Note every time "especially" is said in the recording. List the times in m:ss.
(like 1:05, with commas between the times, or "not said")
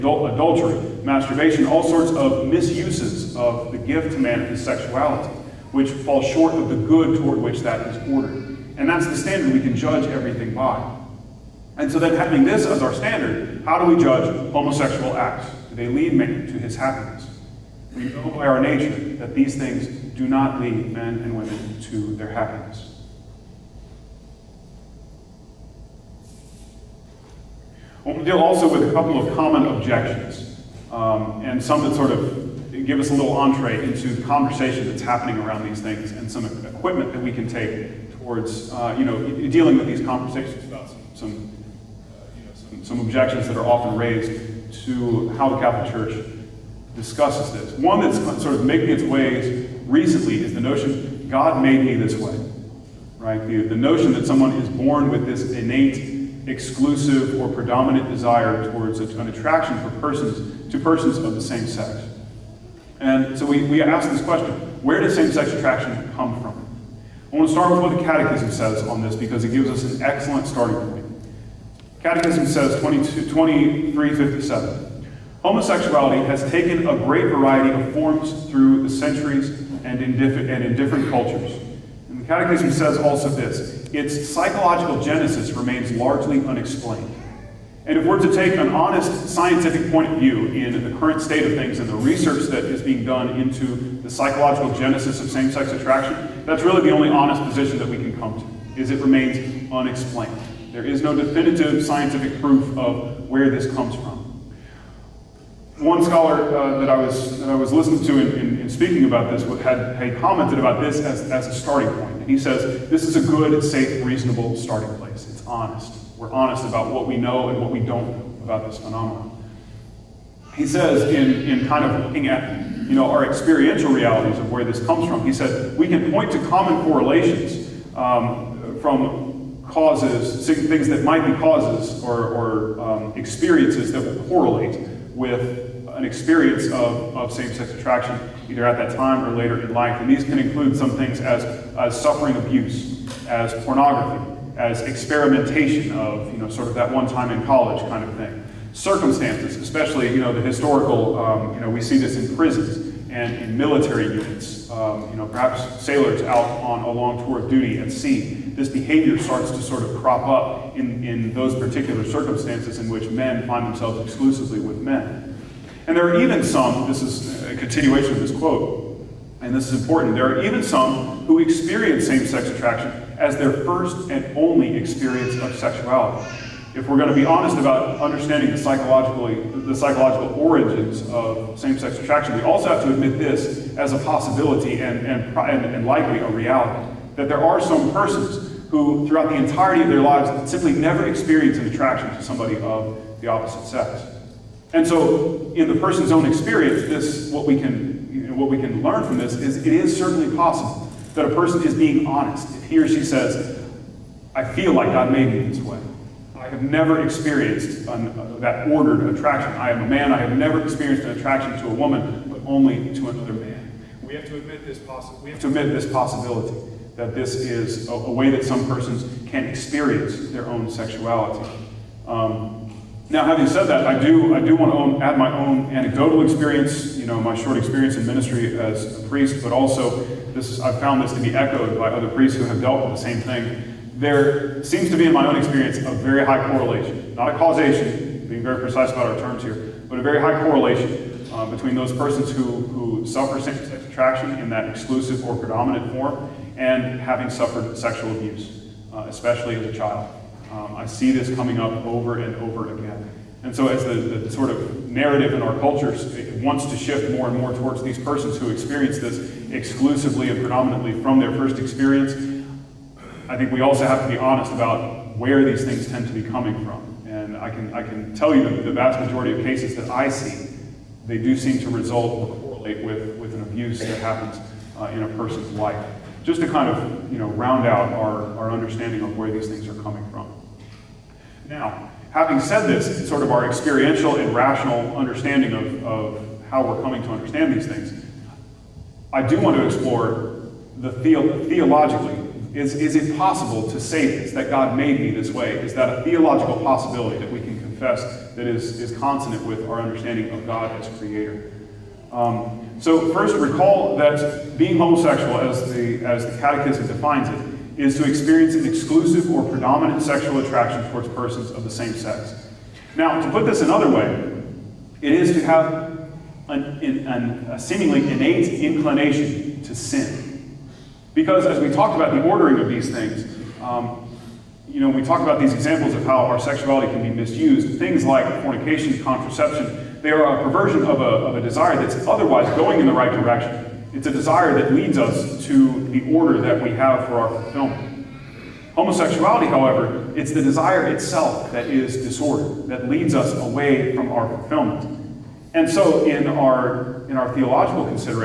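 2:29, 4:09.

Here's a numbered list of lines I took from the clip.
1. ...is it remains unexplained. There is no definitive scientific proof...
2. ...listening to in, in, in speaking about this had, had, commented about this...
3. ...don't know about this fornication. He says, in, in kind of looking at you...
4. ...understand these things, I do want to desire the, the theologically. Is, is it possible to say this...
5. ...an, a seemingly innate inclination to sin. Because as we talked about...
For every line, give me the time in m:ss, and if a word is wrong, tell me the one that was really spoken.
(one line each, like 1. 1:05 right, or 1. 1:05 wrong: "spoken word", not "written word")
1. 1:38 right
2. 1:47 right
3. 1:57 wrong: "phenomenon", not "fornication"
4. 4:47 wrong: "explore", not "desire"
5. 5:17 right.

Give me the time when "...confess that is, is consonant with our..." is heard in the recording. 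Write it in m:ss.
4:57.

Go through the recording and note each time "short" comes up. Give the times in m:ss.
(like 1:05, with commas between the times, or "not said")
0:06, 3:47.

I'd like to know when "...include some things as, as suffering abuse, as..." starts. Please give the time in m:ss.
2:20.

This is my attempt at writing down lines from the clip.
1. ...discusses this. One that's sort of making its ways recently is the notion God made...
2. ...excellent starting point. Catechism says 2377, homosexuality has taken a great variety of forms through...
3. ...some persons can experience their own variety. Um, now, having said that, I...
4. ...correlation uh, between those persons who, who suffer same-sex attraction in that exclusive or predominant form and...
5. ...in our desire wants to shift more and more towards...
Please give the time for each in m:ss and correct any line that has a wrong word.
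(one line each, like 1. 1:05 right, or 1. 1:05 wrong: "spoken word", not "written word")
1. 0:46 right
2. 1:10 wrong: "2357", not "2377"
3. 3:38 wrong: "sexuality", not "variety"
4. 4:00 right
5. 4:15 wrong: "culture", not "desire".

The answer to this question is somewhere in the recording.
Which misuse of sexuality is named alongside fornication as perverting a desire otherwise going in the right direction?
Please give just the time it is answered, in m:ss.
5:29.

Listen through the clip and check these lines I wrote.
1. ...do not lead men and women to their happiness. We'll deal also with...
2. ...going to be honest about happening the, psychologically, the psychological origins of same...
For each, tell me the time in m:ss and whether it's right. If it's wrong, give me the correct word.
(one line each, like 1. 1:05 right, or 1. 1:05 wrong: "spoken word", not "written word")
1. 0:20 right
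2. 2:56 wrong: "understanding", not "happening".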